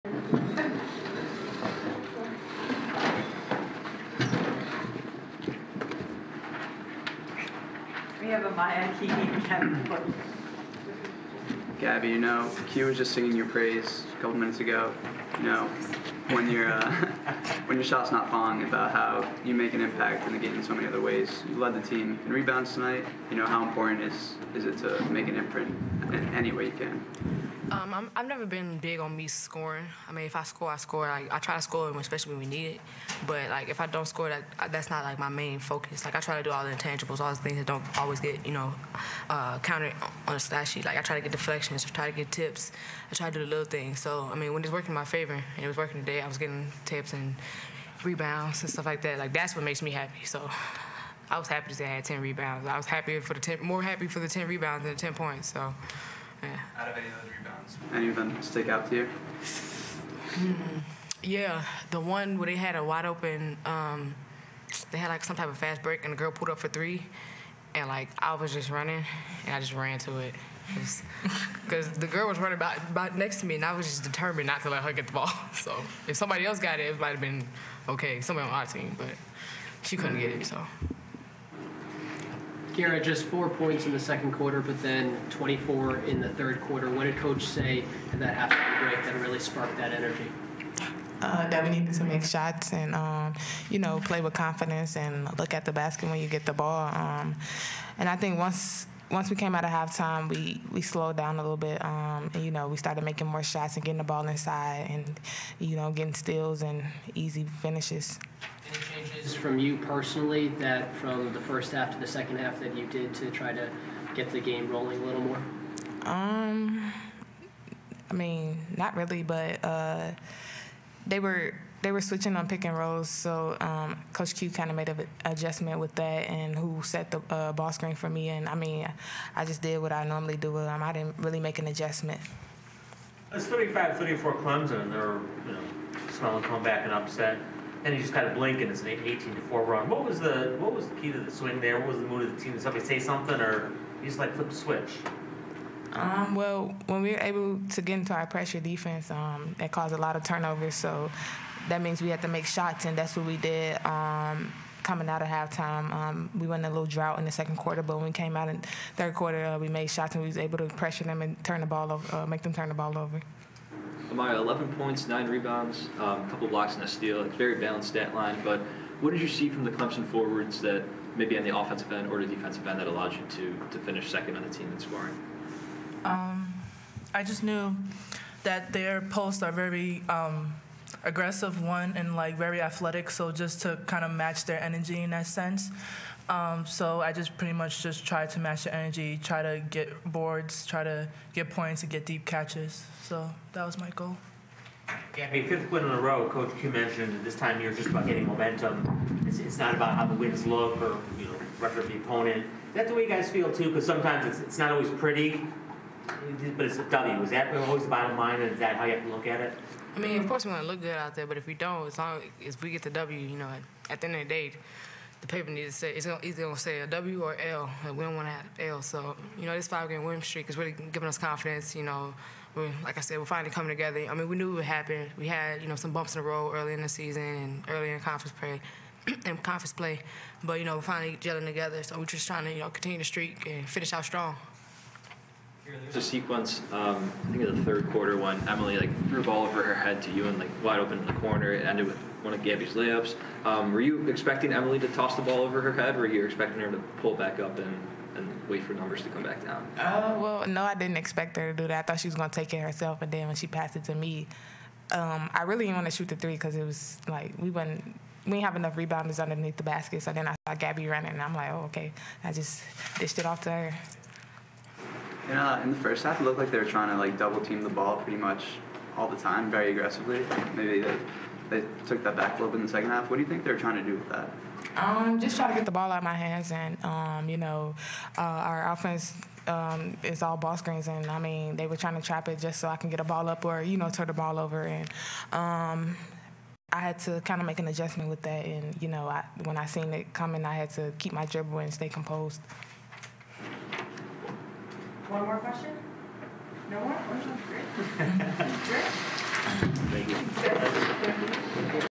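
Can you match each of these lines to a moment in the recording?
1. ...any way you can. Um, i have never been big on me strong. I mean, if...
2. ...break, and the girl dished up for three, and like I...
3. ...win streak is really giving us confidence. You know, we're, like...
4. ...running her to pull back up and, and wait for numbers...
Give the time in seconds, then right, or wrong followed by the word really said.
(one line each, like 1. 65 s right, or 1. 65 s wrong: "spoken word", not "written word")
1. 26 s wrong: "scoring", not "strong"
2. 65 s wrong: "pulled", not "dished"
3. 220 s right
4. 246 s wrong: "expecting", not "running".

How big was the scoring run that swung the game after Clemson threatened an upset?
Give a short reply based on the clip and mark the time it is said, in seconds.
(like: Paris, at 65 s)
18 to 4, at 138 s.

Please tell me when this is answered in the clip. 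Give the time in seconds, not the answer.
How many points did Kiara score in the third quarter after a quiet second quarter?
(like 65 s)
85 s.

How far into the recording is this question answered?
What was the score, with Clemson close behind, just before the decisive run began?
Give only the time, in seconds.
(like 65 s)
133 s.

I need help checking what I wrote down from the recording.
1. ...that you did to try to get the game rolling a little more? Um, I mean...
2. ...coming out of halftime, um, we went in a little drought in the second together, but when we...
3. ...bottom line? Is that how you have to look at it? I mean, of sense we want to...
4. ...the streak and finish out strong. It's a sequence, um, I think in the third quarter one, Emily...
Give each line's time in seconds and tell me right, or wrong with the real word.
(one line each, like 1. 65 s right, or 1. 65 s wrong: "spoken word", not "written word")
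1. 112 s right
2. 154 s wrong: "quarter", not "together"
3. 207 s wrong: "course", not "sense"
4. 232 s right.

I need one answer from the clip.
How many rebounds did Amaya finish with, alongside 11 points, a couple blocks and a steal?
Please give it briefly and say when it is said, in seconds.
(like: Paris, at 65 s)
9, at 165 s.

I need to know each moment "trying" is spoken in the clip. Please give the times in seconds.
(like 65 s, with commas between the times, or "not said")
232 s, 266 s, 273 s, 281 s.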